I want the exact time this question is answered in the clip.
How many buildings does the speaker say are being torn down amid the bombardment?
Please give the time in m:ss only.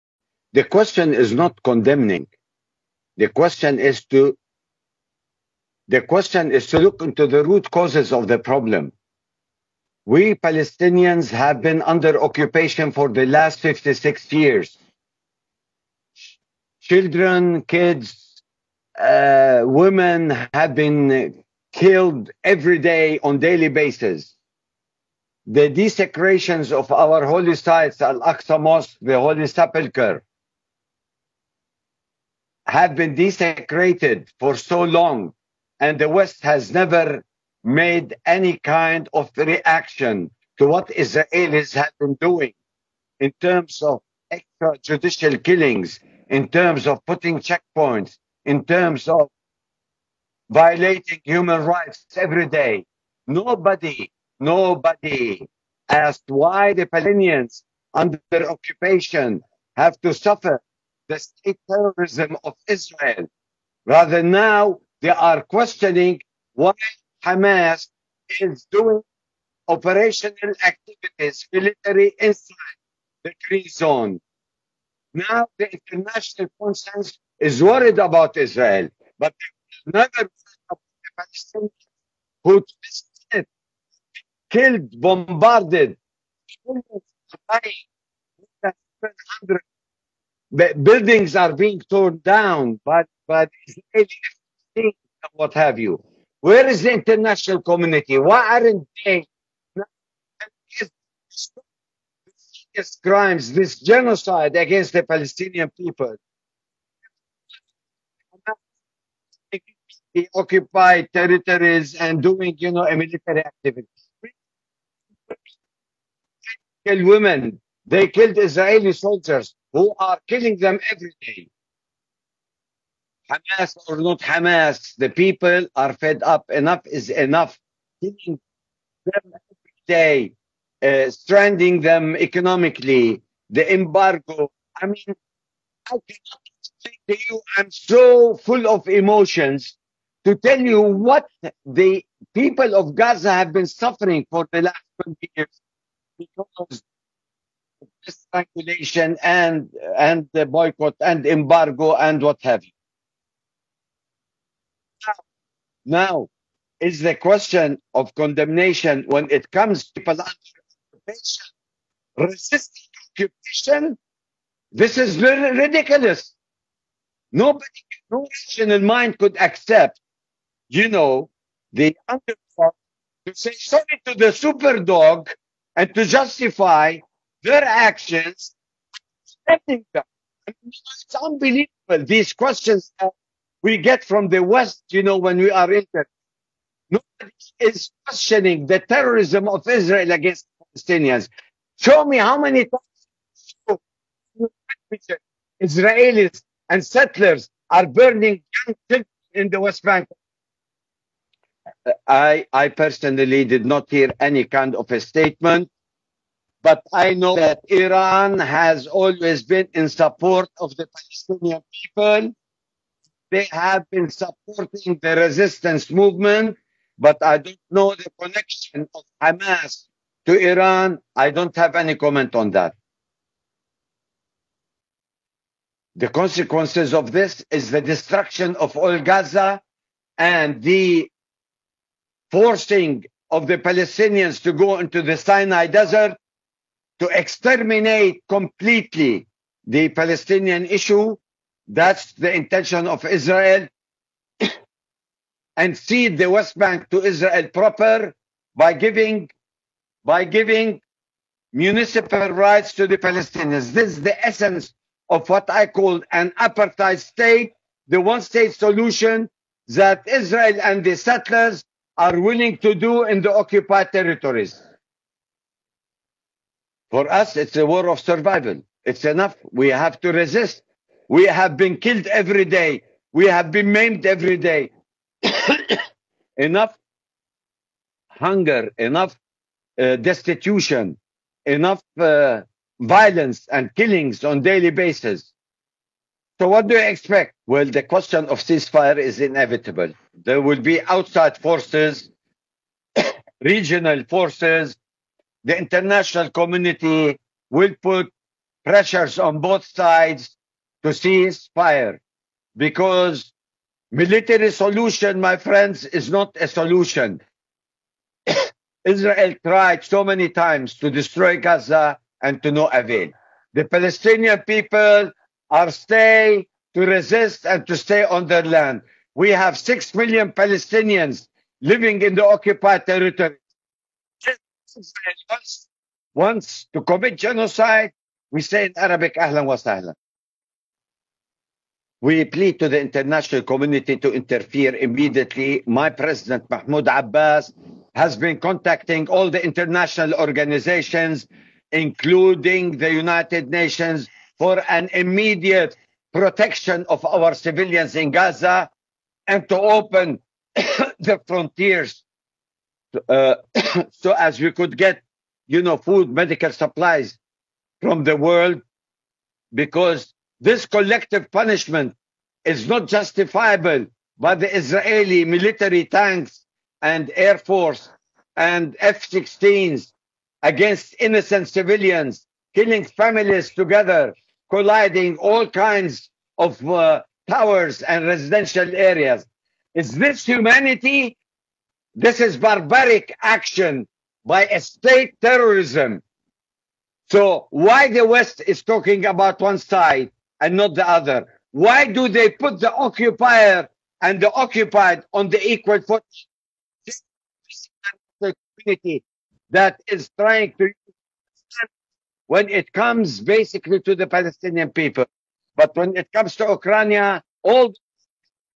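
1:26.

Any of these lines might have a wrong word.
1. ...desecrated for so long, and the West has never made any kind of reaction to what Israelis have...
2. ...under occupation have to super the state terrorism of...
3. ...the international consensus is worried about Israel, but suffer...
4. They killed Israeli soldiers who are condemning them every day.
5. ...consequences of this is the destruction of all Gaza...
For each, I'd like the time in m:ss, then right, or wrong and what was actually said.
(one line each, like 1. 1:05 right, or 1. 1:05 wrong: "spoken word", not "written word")
1. 0:33 right
2. 0:57 wrong: "suffer", not "super"
3. 1:15 wrong: "never", not "suffer"
4. 1:57 wrong: "killing", not "condemning"
5. 3:46 right.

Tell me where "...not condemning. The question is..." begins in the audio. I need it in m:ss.
0:01.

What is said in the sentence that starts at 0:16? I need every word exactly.
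Children, kids, uh, women have been killed every day on daily basis.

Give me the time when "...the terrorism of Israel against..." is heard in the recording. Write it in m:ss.
3:08.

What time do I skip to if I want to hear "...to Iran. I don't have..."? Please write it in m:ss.
3:40.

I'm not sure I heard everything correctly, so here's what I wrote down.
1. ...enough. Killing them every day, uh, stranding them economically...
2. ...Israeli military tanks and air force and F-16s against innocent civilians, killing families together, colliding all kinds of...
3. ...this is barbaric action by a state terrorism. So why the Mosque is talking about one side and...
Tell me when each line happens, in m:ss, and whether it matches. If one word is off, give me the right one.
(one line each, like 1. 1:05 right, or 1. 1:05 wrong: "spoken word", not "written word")
1. 2:07 right
2. 6:04 right
3. 6:21 wrong: "West", not "Mosque".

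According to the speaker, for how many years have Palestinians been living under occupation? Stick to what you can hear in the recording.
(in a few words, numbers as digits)
56.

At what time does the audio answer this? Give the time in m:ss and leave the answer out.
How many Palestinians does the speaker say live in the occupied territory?
5:19.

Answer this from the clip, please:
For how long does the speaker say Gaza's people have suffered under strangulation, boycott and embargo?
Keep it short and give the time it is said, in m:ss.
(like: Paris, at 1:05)
20 years, at 2:25.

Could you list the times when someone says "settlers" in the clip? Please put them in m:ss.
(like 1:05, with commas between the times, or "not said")
3:16, 4:20.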